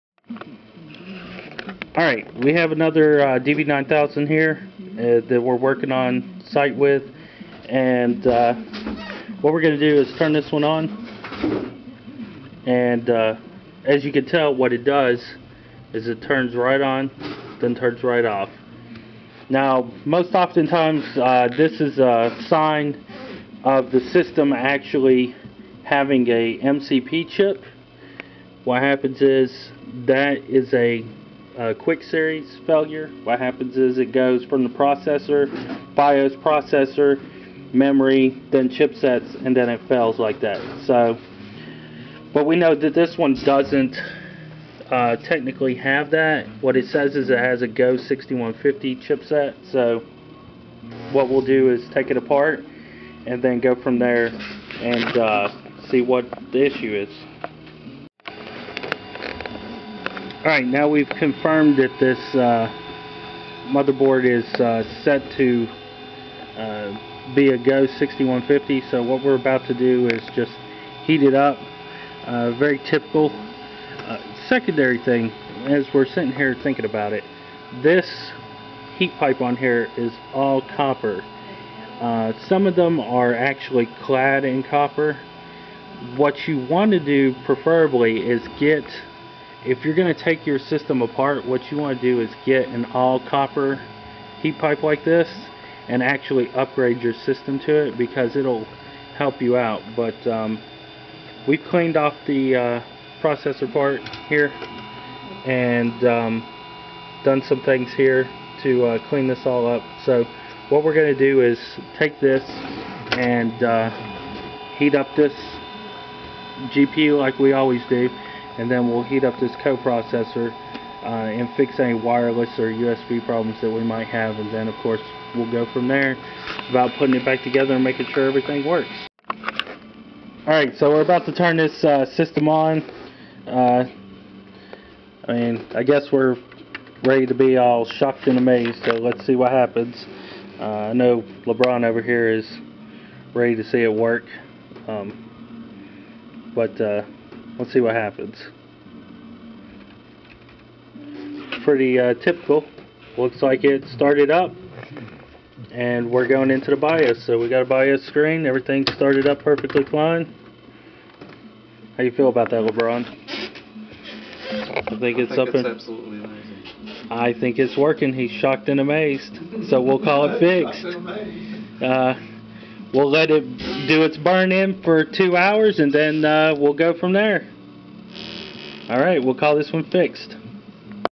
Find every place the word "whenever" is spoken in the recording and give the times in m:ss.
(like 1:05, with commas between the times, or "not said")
not said.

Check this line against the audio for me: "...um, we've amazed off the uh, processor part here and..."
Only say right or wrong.
wrong.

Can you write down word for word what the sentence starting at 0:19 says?
Now most oftentimes uh, this is a sign of the system actually having a MCP chip.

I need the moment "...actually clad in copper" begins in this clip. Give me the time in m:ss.
1:23.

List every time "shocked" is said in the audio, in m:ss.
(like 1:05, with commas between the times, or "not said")
2:17, 2:48.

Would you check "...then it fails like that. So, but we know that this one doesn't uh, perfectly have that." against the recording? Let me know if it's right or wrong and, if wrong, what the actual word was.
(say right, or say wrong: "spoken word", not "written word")
wrong: "technically", not "perfectly".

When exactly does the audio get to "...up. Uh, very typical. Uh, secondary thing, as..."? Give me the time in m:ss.
1:11.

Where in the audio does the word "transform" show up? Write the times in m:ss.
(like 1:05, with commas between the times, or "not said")
not said.